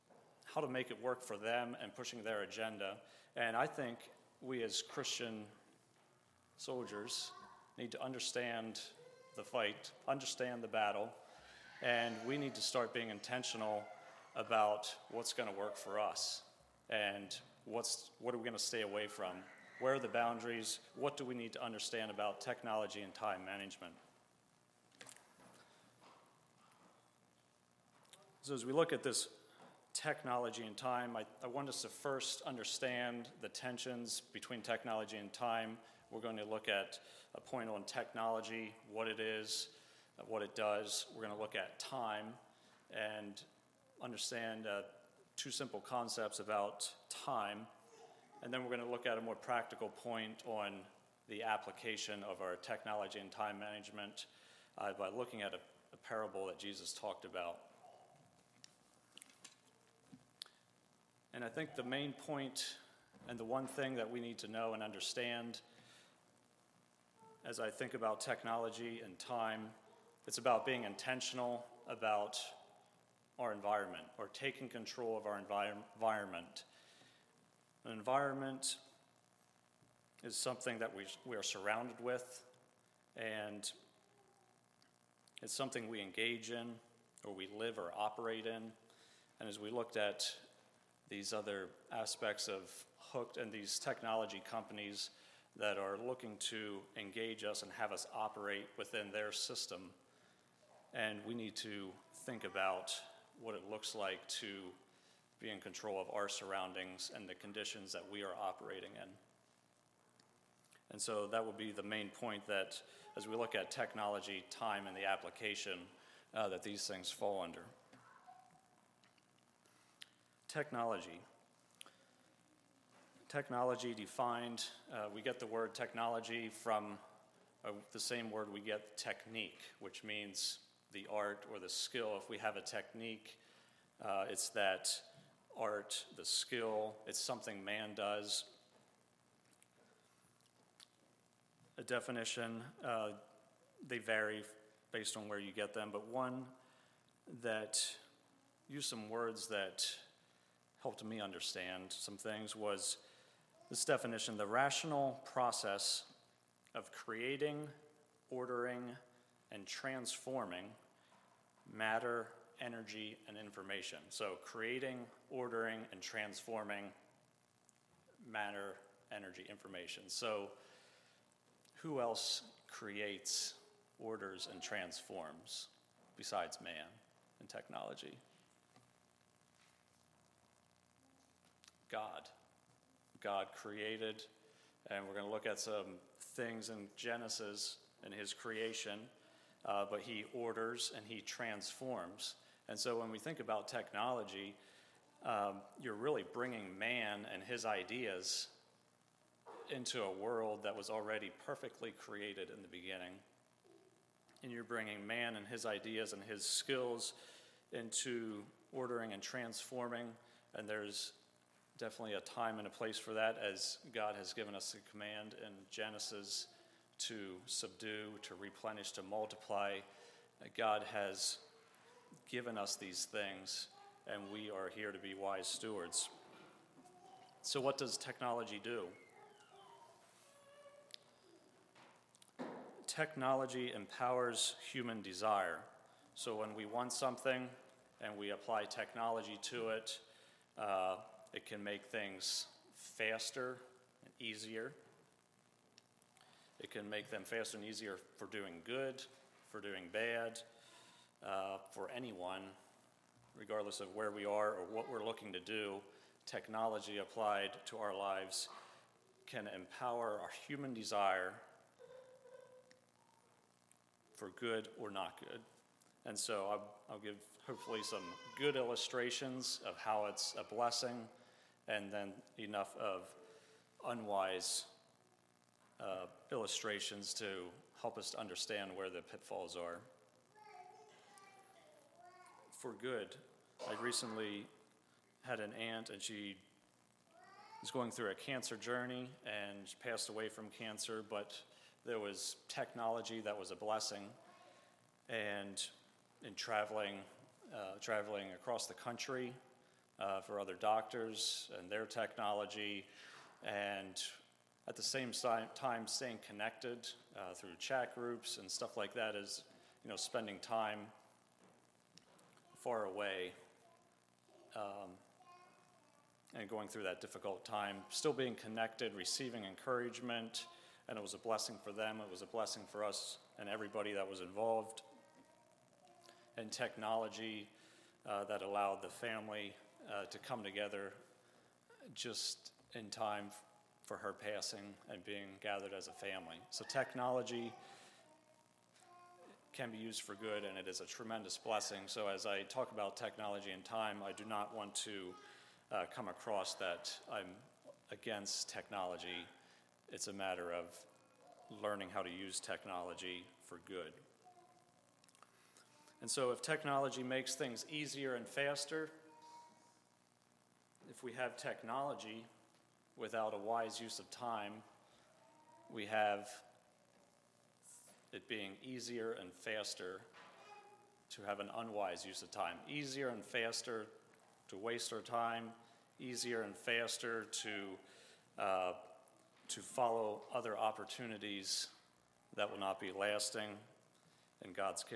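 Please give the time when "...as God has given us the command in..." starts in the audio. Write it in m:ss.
3:33.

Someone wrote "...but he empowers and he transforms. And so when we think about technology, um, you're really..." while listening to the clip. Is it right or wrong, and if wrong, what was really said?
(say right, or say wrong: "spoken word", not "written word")
wrong: "orders", not "empowers".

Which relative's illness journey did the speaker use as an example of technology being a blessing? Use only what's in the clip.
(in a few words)
aunt.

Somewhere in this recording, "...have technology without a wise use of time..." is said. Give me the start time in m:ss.
6:01.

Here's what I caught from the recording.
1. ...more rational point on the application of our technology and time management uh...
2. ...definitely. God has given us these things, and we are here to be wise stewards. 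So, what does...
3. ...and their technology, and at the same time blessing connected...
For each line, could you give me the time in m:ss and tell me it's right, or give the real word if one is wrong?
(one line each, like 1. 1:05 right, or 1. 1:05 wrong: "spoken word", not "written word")
1. 0:49 wrong: "practical", not "rational"
2. 3:39 wrong: "multiply", not "definitely"
3. 5:01 wrong: "staying", not "blessing".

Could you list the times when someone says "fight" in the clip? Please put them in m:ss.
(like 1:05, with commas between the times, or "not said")
0:09.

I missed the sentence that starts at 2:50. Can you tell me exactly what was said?
So who else creates, orders, and transforms besides man and technology?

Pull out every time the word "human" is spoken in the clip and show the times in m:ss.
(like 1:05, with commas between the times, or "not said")
3:54, 4:20.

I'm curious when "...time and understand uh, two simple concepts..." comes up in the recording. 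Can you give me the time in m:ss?
0:41.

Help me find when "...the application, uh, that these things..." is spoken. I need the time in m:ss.
1:54.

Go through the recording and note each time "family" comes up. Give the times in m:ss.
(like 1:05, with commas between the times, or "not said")
5:28, 5:35.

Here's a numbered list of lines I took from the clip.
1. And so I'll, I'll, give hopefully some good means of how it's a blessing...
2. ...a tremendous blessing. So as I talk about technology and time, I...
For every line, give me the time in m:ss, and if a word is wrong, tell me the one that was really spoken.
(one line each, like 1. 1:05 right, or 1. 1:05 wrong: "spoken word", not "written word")
1. 4:26 wrong: "illustrations", not "means"
2. 5:40 right.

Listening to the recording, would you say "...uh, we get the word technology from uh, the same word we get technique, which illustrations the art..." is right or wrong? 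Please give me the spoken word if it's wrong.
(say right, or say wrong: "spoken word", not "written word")
wrong: "means", not "illustrations".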